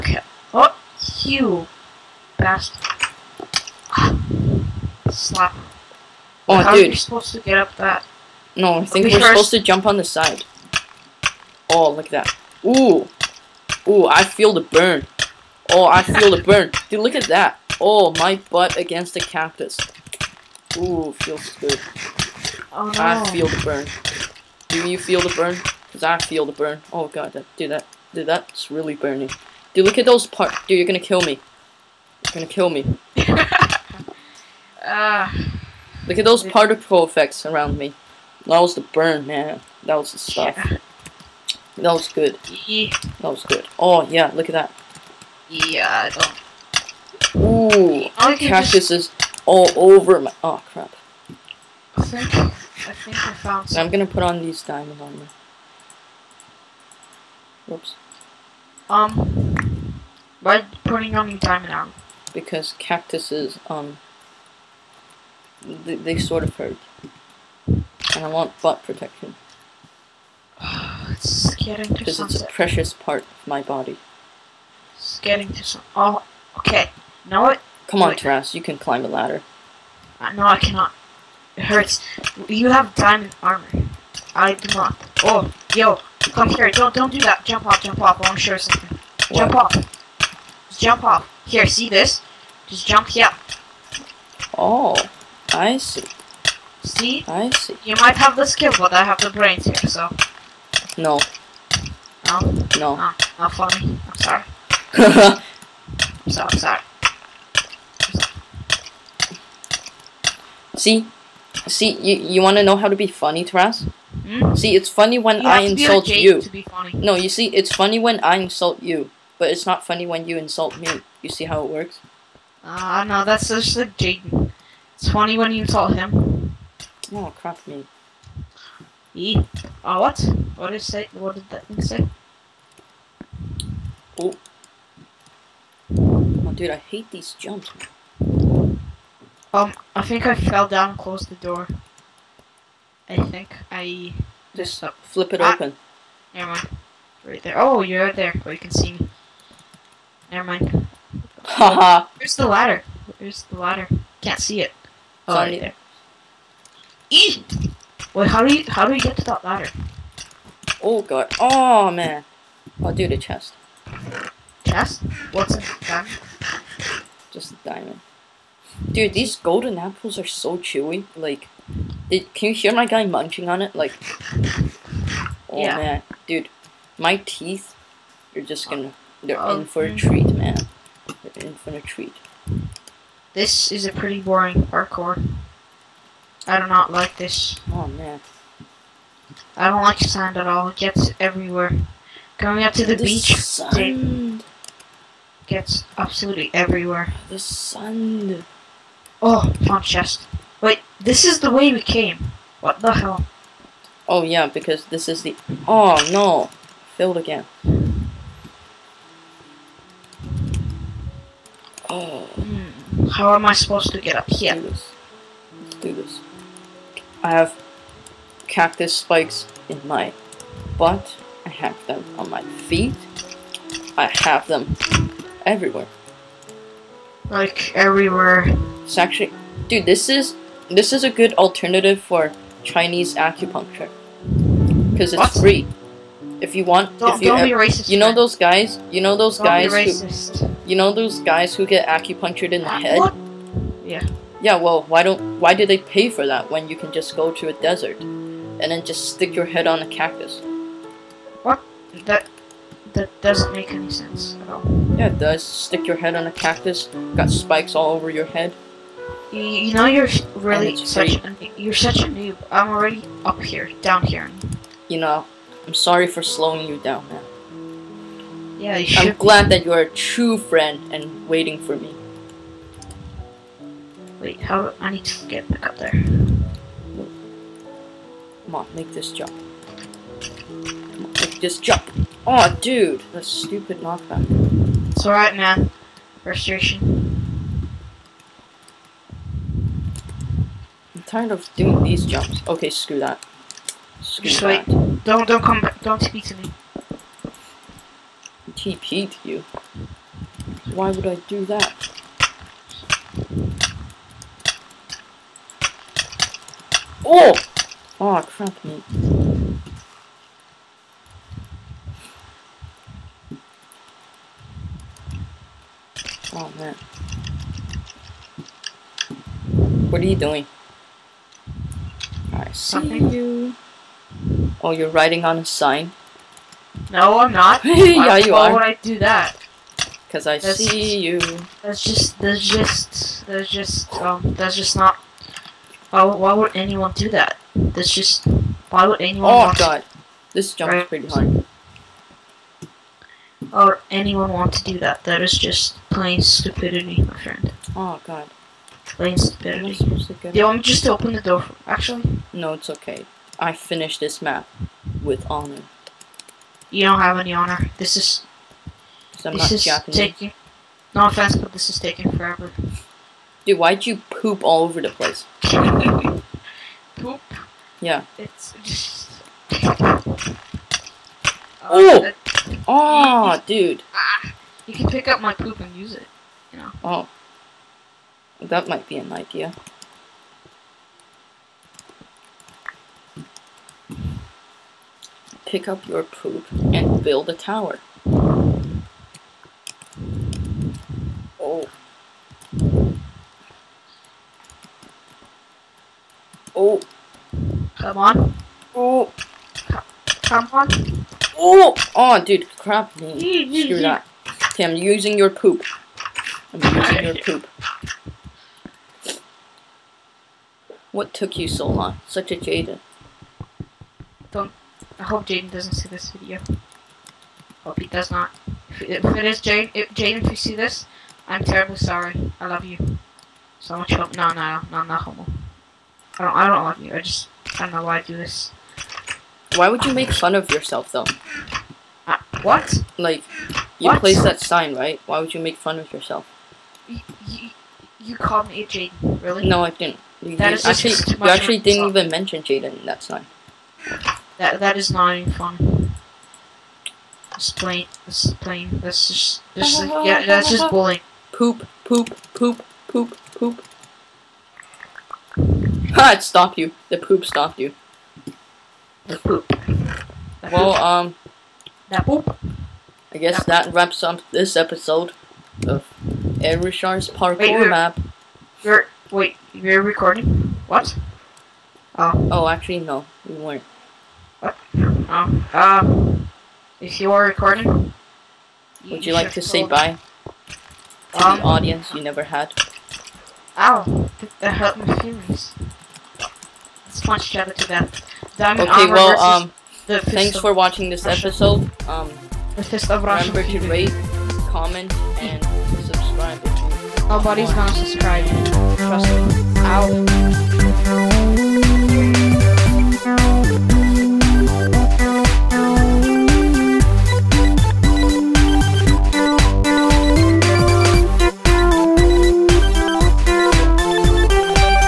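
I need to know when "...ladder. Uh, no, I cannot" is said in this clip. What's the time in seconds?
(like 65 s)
79 s.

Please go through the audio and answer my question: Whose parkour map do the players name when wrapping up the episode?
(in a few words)
Richard's.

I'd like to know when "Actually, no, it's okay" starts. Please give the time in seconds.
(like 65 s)
351 s.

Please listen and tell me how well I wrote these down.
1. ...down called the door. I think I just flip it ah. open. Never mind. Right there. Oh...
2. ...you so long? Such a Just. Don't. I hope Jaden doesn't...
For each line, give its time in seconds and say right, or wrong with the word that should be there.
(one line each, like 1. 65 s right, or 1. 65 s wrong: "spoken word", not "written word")
1. 140 s wrong: "closed", not "called"
2. 411 s wrong: "Jaden", not "Just".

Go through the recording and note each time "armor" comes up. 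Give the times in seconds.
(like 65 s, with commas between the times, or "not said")
55 s, 61 s, 83 s.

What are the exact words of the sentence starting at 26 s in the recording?
Oh god, that, dude, that, dude, that's really burning.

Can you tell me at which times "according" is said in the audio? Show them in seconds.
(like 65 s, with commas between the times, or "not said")
not said.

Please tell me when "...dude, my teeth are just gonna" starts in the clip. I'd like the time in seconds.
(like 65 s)
176 s.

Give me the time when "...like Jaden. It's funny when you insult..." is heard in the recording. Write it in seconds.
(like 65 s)
123 s.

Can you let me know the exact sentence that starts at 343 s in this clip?
Or anyone want to do that?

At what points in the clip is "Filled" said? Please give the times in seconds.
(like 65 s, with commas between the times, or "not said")
206 s.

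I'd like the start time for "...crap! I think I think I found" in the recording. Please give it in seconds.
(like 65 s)
50 s.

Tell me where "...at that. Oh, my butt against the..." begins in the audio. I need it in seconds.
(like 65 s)
17 s.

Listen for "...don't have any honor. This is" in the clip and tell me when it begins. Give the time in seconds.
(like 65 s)
356 s.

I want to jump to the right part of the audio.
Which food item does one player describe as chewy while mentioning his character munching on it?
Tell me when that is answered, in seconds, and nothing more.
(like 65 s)
169 s.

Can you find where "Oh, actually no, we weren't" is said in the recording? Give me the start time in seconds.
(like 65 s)
472 s.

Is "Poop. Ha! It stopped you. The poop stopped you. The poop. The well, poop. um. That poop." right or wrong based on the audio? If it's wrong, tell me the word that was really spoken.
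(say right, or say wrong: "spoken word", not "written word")
right.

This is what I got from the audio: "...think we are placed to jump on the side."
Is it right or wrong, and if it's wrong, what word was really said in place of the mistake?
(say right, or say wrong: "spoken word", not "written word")
wrong: "supposed", not "placed".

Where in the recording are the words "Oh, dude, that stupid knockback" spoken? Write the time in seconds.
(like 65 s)
282 s.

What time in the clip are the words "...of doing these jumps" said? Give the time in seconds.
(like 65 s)
291 s.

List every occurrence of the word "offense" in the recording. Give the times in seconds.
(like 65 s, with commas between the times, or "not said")
361 s.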